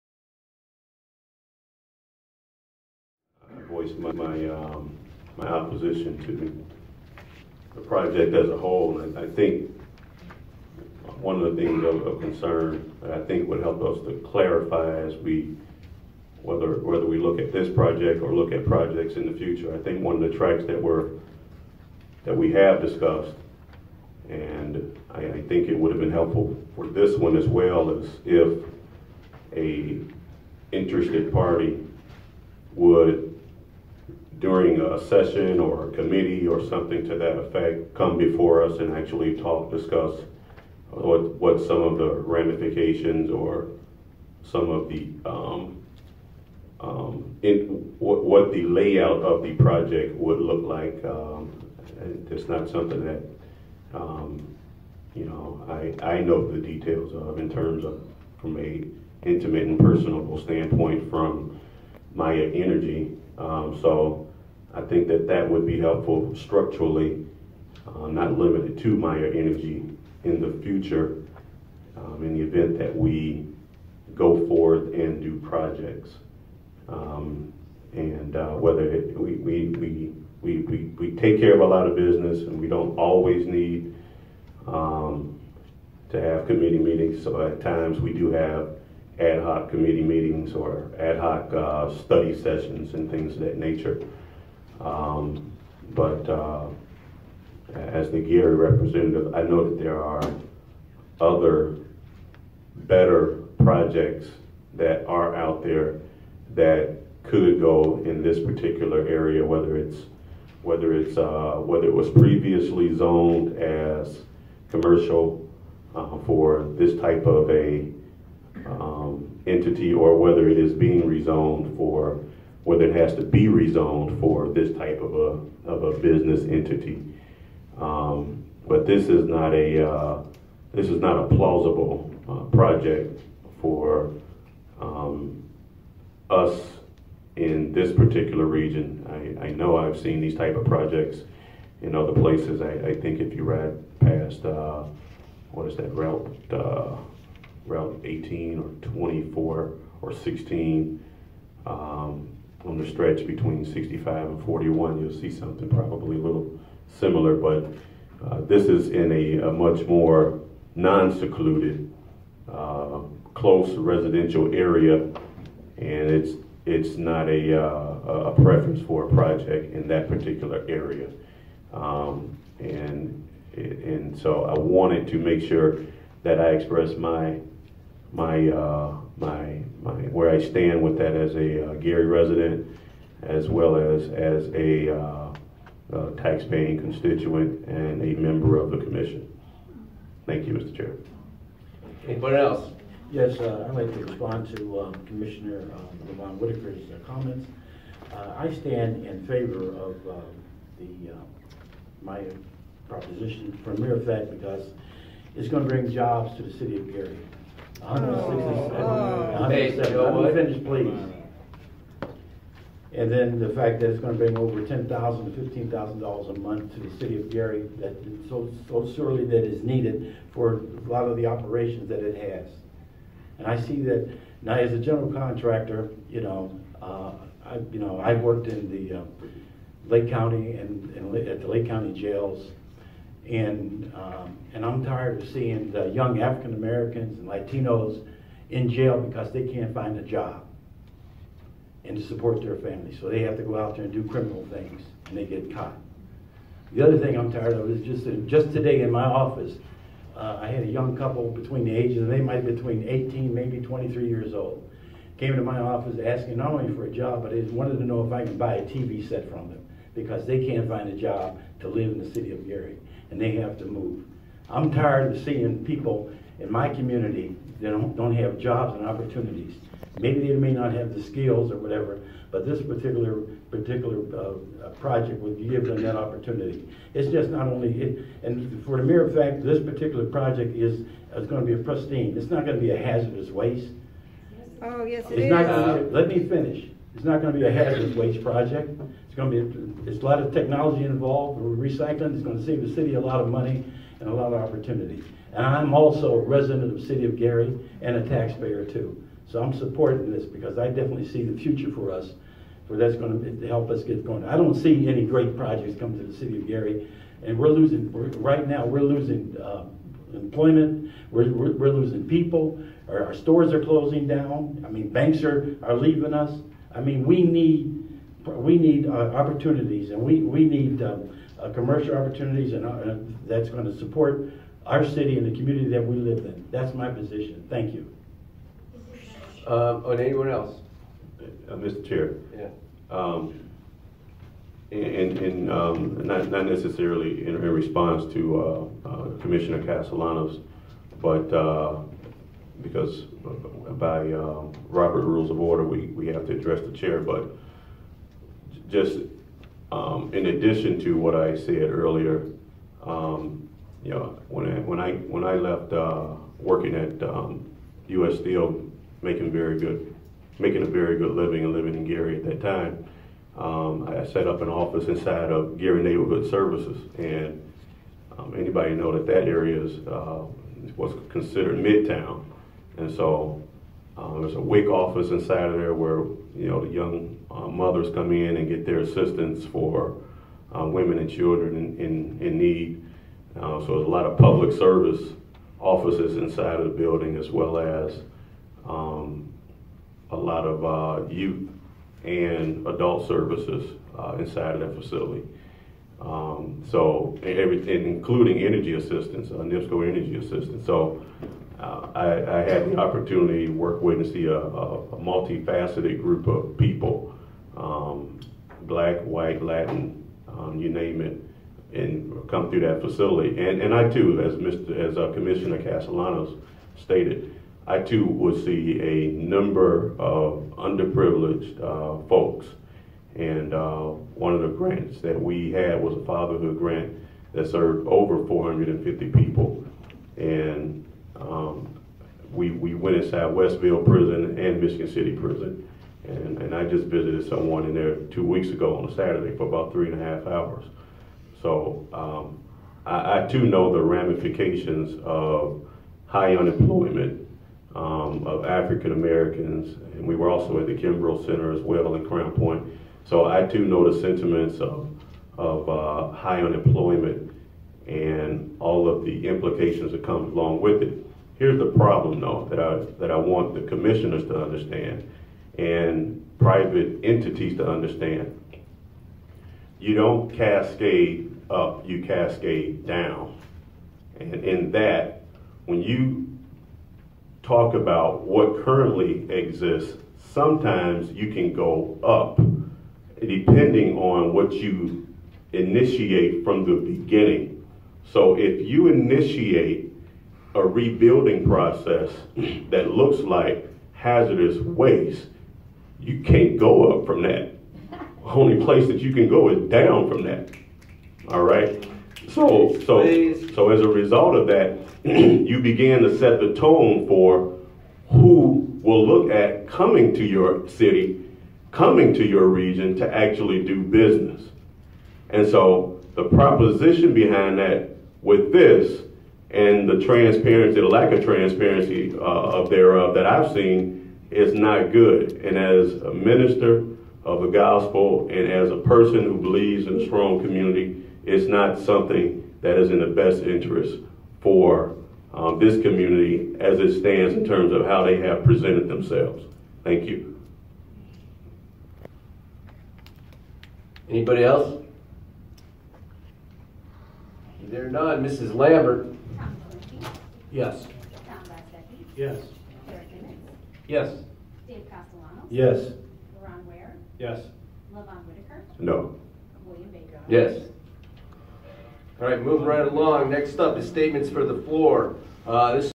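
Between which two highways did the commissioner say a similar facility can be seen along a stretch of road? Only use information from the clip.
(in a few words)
65 and 41.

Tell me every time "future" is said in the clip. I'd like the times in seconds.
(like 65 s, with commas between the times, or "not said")
19 s, 70 s, 301 s.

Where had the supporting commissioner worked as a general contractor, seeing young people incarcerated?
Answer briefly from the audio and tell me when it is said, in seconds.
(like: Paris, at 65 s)
Lake County jails, at 231 s.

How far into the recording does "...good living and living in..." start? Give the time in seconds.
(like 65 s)
360 s.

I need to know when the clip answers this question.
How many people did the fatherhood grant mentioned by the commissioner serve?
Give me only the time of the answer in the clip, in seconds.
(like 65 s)
427 s.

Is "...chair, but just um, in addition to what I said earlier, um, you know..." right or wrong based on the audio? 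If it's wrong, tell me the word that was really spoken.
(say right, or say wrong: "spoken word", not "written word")
right.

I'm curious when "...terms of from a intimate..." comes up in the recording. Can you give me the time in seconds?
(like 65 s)
57 s.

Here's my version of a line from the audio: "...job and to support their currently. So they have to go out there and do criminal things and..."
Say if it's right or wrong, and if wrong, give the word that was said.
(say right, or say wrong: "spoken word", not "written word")
wrong: "family", not "currently".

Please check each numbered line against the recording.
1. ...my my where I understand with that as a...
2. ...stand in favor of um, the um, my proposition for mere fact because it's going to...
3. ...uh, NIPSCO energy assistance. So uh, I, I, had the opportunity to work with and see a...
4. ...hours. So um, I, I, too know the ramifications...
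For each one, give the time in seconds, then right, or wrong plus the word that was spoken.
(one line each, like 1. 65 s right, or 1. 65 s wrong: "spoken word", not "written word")
1. 179 s wrong: "stand", not "understand"
2. 198 s right
3. 399 s right
4. 440 s right.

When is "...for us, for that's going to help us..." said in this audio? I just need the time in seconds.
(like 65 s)
301 s.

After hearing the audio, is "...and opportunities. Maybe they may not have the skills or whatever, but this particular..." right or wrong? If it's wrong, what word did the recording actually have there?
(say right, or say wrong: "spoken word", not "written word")
right.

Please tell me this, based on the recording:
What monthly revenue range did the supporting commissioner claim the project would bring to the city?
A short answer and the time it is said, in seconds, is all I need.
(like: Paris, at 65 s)
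$10,000 to $15,000, at 214 s.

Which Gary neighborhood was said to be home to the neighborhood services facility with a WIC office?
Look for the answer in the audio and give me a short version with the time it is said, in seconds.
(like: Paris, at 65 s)
Midtown, at 371 s.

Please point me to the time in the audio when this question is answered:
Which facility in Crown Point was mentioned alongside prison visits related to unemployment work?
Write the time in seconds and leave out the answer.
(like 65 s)
450 s.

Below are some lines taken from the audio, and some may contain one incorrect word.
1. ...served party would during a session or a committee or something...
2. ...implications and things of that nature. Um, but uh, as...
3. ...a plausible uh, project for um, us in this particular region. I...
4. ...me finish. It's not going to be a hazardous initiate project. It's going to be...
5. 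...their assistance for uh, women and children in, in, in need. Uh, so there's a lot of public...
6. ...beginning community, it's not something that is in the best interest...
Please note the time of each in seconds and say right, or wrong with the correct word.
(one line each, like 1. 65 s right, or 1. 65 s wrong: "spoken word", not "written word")
1. 30 s wrong: "interested", not "served"
2. 92 s wrong: "sessions", not "implications"
3. 131 s right
4. 286 s wrong: "waste", not "initiate"
5. 378 s right
6. 530 s wrong: "strong", not "beginning".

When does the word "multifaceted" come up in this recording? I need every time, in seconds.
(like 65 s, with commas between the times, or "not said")
404 s.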